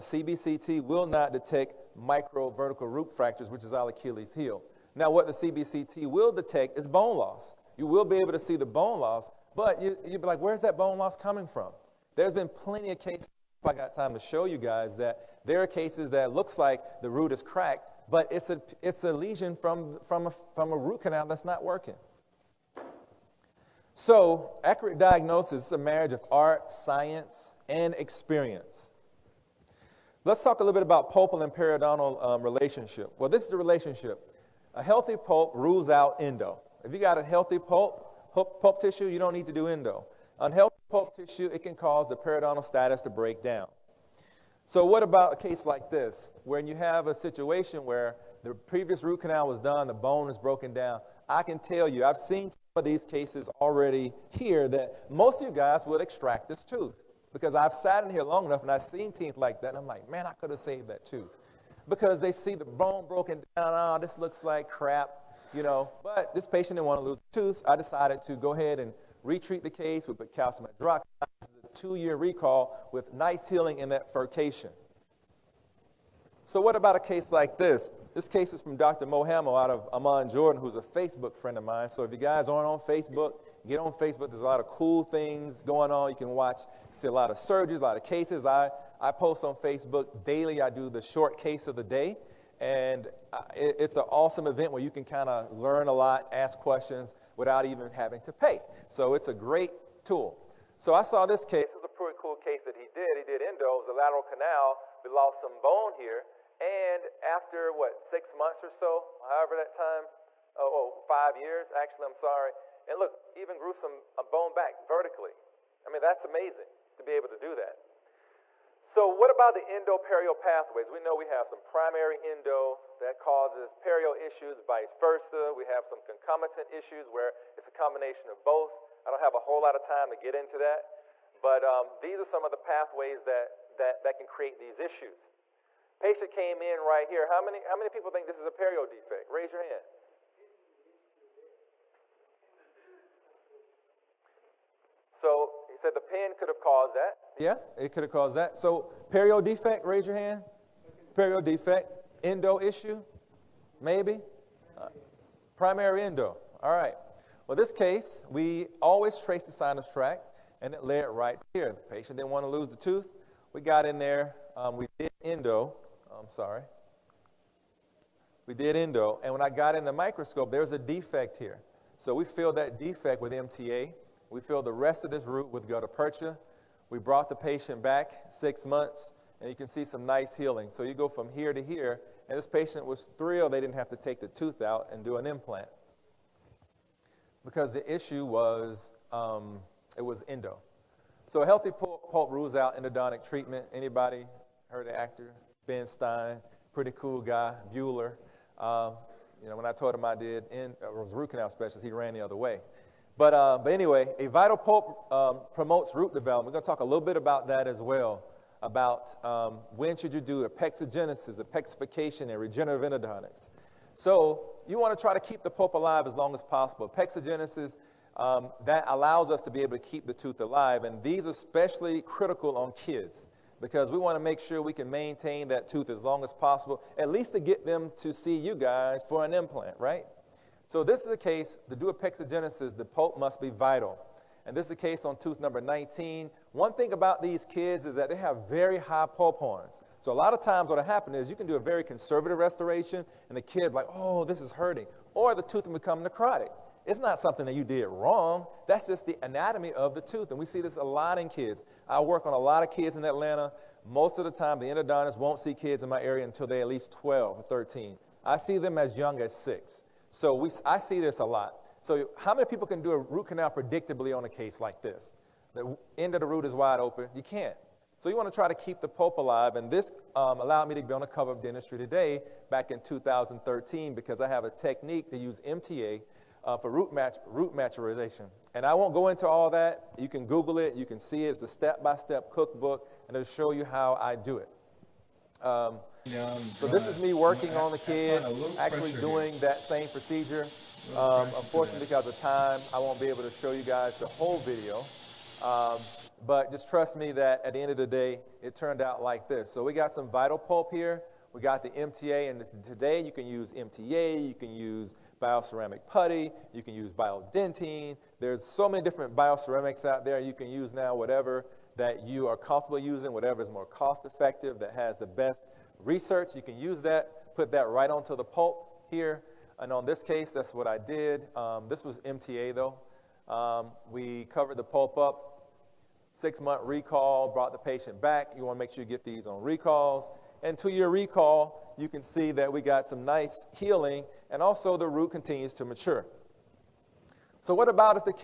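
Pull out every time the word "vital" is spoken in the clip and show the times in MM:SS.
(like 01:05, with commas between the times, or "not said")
03:24, 03:53, 05:00.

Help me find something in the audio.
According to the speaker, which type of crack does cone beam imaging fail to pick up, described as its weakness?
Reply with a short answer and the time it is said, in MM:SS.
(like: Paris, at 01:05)
Micro vertical root fractures, at 00:01.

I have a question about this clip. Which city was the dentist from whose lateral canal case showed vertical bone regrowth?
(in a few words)
Amman, Jordan.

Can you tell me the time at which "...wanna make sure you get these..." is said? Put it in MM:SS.
05:28.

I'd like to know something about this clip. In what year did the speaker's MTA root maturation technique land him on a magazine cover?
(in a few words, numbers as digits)
2013.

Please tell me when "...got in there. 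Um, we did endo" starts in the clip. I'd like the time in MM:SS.
02:43.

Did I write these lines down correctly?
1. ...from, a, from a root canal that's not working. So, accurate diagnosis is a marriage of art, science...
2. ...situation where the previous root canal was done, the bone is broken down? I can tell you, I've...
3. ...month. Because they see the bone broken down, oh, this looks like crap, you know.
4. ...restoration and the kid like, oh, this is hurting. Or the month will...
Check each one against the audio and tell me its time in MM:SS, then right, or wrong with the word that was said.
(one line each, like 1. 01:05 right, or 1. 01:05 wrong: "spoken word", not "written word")
1. 00:20 right
2. 00:47 right
3. 01:01 wrong: "tooth", not "month"
4. 04:02 wrong: "tooth", not "month".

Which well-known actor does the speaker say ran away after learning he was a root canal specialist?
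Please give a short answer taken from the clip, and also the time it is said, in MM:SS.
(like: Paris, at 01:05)
Ben Stein, at 03:15.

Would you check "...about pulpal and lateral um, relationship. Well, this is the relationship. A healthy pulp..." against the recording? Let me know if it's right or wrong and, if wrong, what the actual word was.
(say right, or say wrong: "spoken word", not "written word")
wrong: "periodontal", not "lateral".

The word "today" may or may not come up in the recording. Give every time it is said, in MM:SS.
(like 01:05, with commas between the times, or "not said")
04:31, 05:02.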